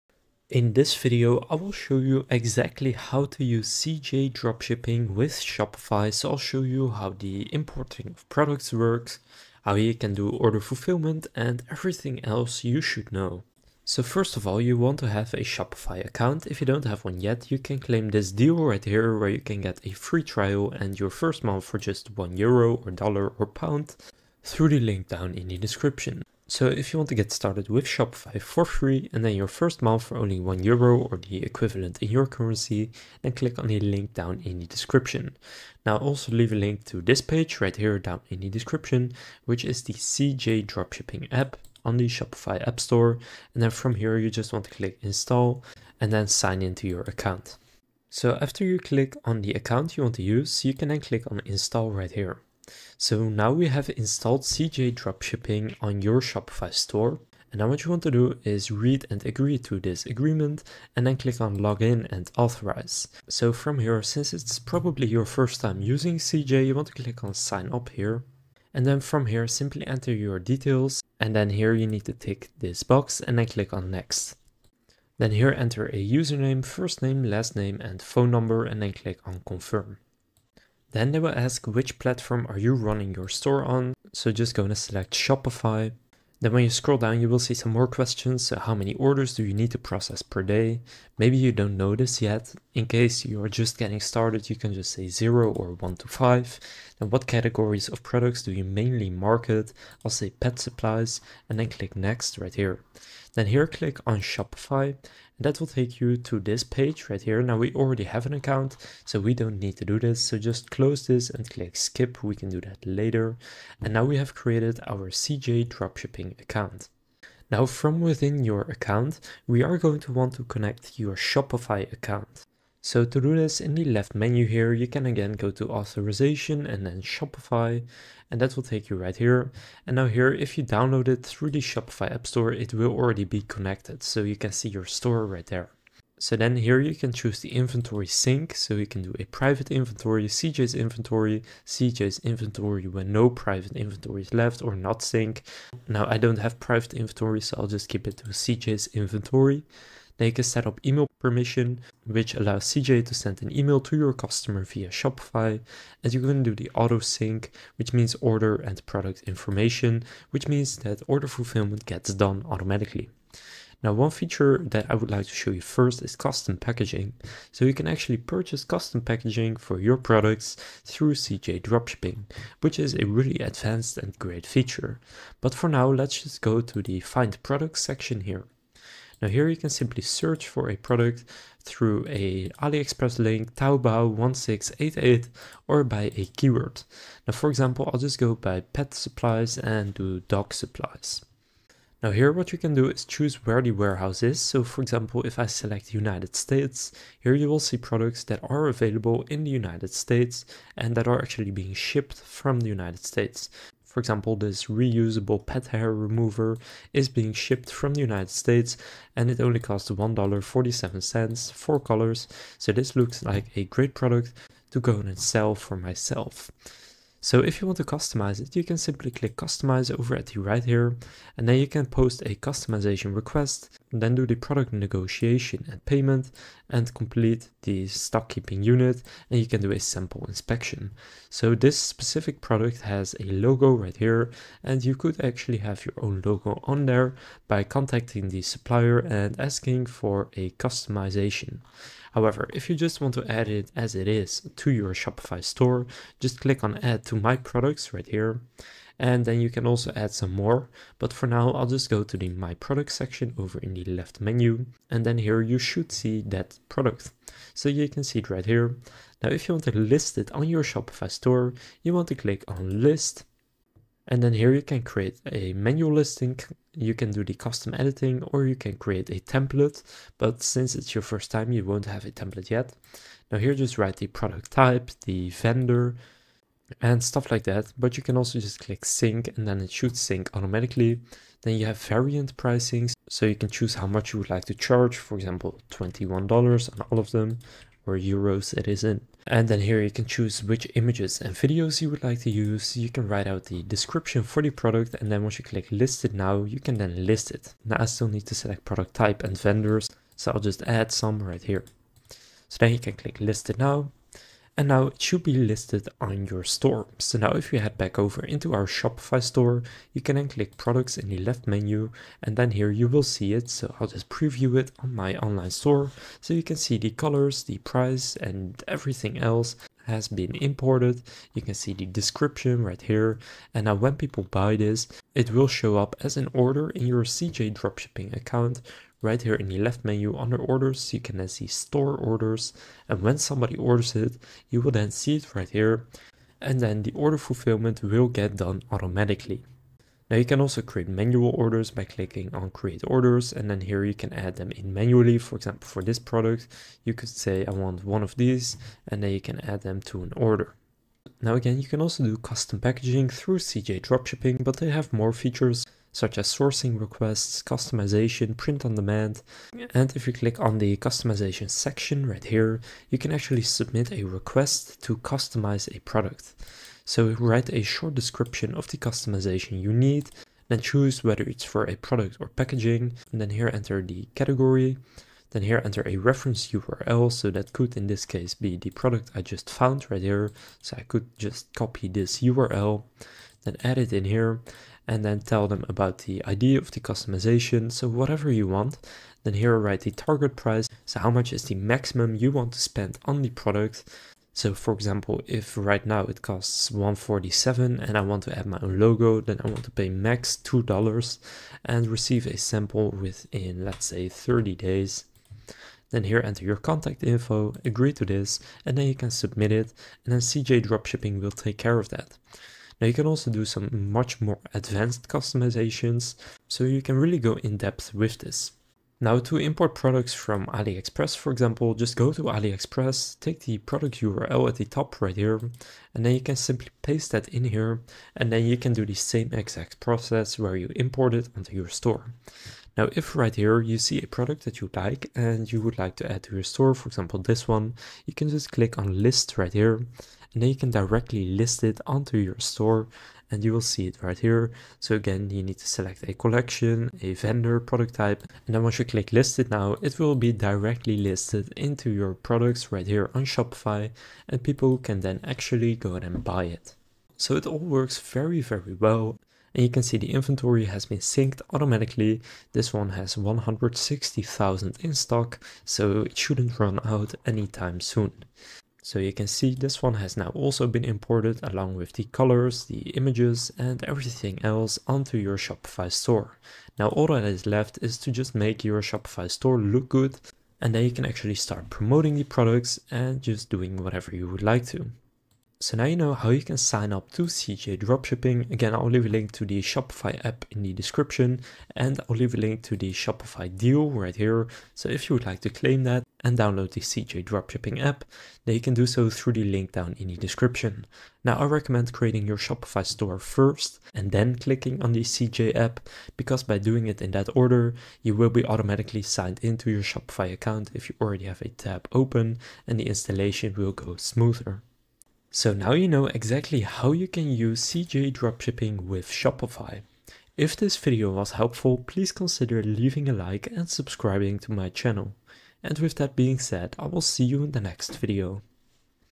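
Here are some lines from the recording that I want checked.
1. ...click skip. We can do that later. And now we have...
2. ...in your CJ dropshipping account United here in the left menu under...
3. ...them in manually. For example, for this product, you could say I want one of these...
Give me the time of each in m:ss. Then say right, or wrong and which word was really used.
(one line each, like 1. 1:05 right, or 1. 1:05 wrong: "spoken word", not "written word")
1. 1:51 right
2. 5:26 wrong: "Right", not "United"
3. 5:44 right.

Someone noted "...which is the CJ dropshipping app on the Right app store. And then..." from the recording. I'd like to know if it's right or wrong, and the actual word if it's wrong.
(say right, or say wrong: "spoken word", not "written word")
wrong: "Shopify", not "Right".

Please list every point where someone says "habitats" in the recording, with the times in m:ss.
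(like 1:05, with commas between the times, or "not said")
not said.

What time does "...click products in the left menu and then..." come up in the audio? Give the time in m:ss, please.
5:10.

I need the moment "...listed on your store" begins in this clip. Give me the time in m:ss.
5:05.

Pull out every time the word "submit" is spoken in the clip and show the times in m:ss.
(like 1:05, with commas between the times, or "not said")
6:03, 6:49.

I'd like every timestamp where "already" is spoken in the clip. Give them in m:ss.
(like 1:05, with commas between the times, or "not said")
1:47, 2:12, 8:31.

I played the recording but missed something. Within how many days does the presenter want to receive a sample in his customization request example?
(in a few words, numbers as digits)
30 days.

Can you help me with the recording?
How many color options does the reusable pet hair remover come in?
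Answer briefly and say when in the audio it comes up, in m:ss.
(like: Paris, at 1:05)
4, at 3:31.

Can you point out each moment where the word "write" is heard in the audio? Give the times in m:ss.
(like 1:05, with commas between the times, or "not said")
4:33, 4:53, 6:07, 6:29.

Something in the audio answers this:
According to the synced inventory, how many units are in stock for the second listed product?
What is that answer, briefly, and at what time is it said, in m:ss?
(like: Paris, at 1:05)
160,000, at 7:43.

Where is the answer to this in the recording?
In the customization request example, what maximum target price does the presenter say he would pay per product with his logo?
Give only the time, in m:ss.
6:40.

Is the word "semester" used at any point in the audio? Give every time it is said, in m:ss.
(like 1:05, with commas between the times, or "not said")
not said.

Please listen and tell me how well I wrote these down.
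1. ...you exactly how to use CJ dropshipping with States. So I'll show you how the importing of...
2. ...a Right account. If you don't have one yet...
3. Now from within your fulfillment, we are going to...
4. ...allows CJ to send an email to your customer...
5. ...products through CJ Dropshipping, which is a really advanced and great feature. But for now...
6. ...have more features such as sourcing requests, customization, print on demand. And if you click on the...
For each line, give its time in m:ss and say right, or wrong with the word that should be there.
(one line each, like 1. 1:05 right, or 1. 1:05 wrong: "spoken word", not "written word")
1. 0:01 wrong: "Shopify", not "States"
2. 0:15 wrong: "Shopify", not "Right"
3. 1:57 wrong: "account", not "fulfillment"
4. 2:32 right
5. 2:49 right
6. 5:54 right.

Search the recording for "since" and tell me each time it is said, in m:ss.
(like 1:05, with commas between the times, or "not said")
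1:04, 4:30.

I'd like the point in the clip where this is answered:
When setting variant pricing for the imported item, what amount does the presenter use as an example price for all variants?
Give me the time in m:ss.
4:45.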